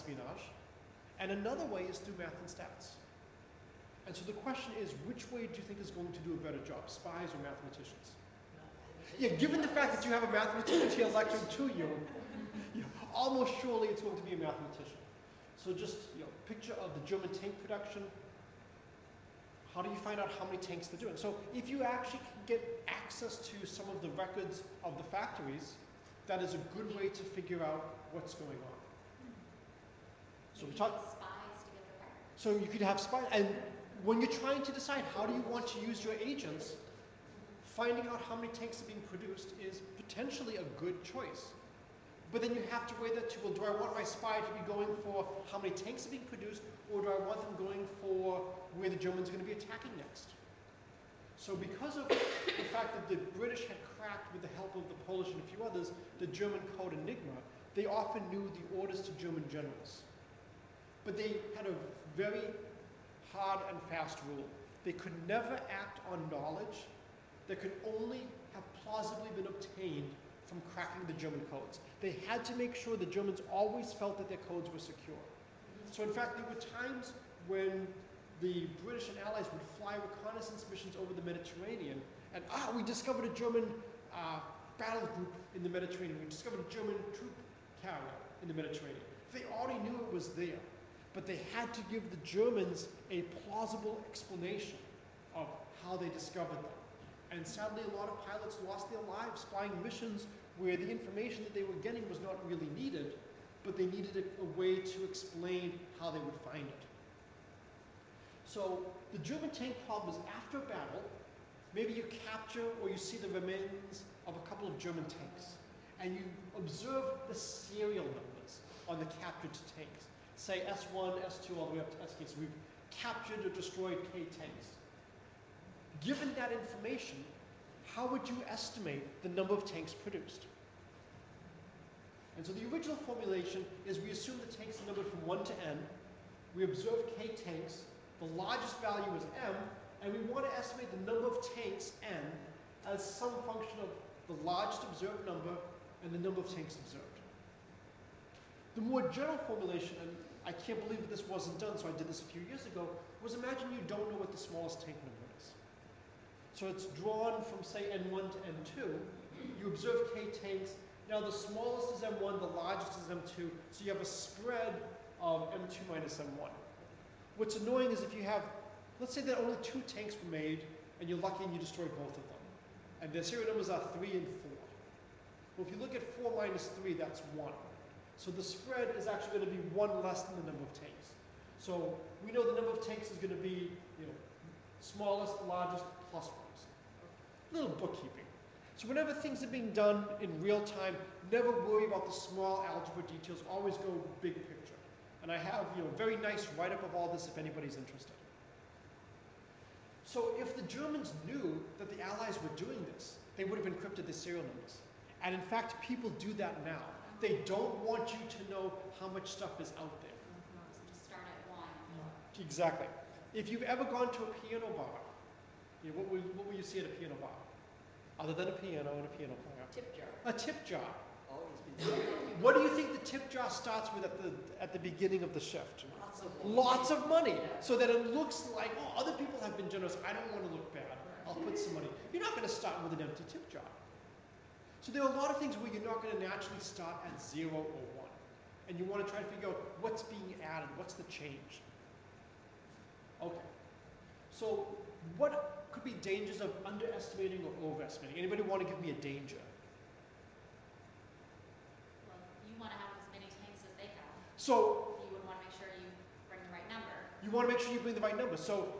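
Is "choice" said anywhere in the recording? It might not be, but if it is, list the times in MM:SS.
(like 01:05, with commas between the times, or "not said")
00:41.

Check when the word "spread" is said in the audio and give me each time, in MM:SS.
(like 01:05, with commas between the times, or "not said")
02:44, 02:58.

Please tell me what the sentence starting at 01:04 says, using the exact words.
They could never act on knowledge that could only have plausibly been obtained from cracking the German codes.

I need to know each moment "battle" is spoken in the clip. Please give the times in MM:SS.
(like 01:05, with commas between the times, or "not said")
01:24, 01:50.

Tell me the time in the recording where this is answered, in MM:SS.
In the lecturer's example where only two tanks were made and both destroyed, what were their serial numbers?
02:53.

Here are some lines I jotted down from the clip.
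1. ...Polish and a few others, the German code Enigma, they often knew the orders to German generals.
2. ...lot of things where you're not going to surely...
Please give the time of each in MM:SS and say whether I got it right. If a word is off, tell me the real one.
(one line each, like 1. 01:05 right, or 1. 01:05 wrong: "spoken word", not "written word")
1. 00:55 right
2. 03:55 wrong: "naturally", not "surely".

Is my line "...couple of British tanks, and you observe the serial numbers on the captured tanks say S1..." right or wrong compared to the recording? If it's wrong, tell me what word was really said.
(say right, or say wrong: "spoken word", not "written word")
wrong: "German", not "British".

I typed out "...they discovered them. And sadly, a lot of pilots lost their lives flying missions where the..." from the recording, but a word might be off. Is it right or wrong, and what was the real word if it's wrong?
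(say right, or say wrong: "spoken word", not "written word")
right.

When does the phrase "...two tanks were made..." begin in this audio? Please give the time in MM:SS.
02:49.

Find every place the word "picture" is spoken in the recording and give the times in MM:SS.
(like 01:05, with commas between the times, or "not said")
00:16, 03:14.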